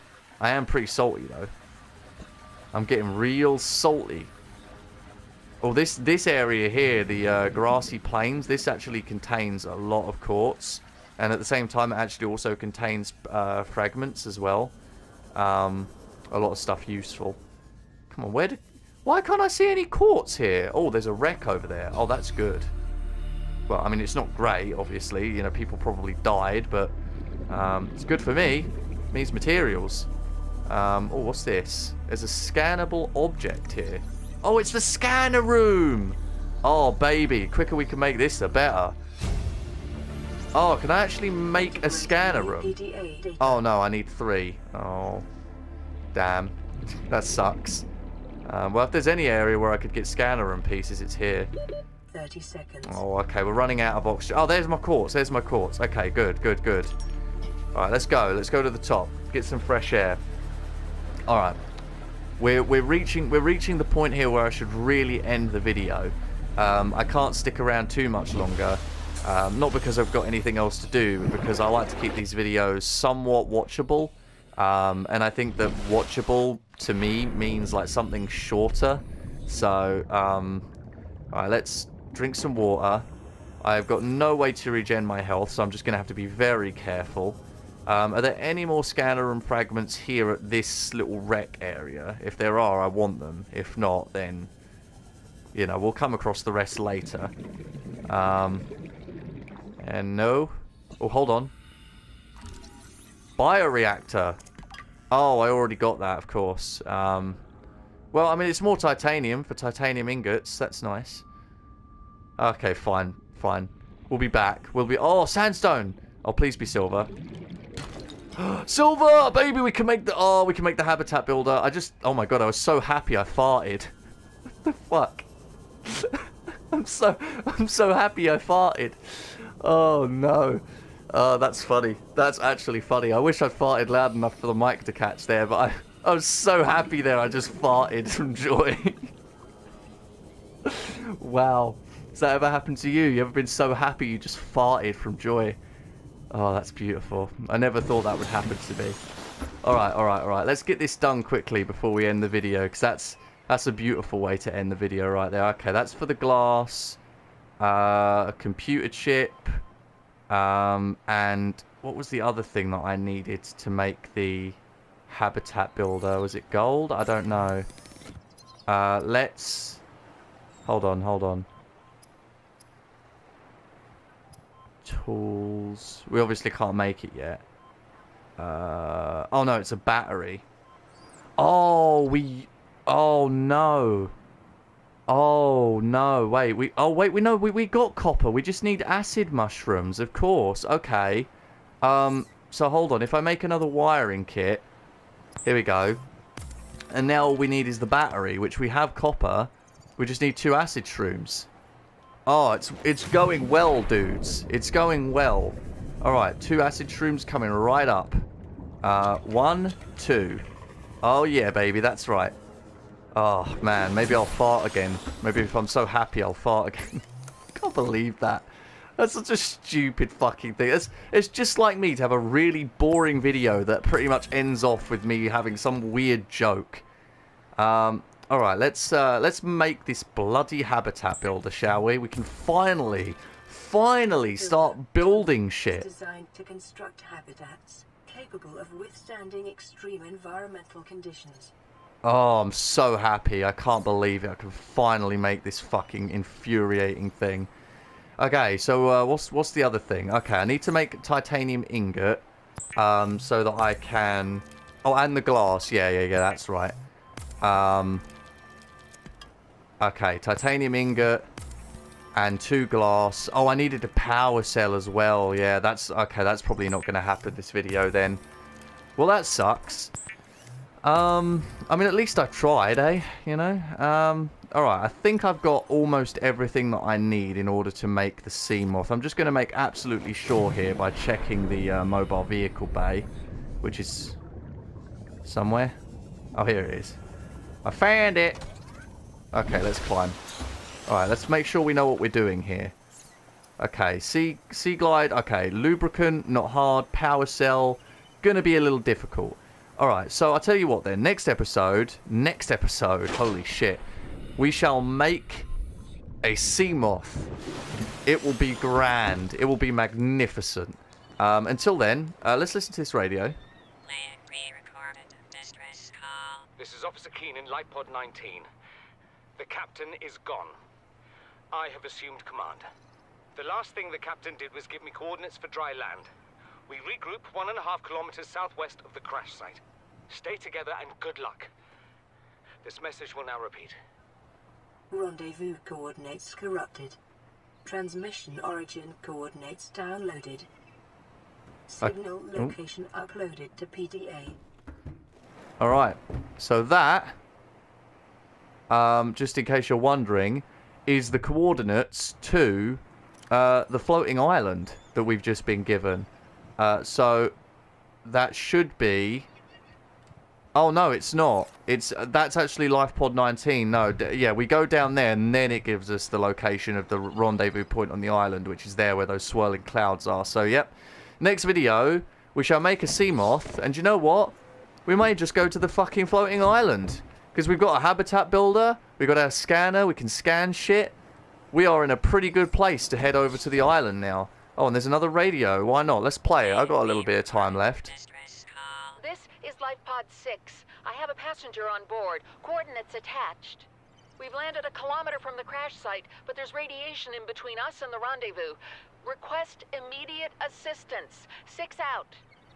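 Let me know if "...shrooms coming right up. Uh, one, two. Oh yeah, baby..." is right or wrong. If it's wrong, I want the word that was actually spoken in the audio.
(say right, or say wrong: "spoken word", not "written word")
right.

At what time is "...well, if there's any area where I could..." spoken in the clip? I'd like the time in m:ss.
0:48.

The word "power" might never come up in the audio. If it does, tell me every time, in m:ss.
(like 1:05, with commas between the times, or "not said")
4:23, 4:56.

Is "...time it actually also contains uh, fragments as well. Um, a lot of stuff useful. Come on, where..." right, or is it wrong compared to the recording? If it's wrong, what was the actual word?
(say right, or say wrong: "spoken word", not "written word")
right.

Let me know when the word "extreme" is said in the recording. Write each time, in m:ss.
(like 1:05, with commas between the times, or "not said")
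3:59.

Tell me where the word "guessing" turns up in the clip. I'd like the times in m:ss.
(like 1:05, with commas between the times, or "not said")
not said.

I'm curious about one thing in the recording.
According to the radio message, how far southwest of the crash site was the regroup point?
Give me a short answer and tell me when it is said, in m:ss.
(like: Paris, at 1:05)
1.5 kilometers, at 5:27.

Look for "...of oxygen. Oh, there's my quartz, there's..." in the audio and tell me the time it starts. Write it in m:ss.
0:53.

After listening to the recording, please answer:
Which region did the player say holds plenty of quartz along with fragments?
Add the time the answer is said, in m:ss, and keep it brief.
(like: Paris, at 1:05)
grassy plains, at 0:07.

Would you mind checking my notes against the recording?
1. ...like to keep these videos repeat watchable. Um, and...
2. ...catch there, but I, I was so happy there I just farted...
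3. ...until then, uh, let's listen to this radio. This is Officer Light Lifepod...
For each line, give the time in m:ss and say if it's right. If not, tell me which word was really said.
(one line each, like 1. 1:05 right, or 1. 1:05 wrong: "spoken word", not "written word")
1. 1:11 wrong: "somewhat", not "repeat"
2. 2:14 right
3. 5:11 right.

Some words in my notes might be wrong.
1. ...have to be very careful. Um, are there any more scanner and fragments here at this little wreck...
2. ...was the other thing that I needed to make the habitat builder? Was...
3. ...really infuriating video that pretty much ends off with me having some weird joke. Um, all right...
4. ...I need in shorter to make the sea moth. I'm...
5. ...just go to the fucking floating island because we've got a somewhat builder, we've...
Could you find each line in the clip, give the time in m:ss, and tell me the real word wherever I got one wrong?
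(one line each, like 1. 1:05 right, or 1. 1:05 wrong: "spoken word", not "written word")
1. 1:25 right
2. 2:41 right
3. 3:42 wrong: "boring", not "infuriating"
4. 4:36 wrong: "order", not "shorter"
5. 6:15 wrong: "habitat", not "somewhat".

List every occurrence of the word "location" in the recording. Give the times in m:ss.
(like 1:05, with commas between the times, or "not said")
5:42, 6:06.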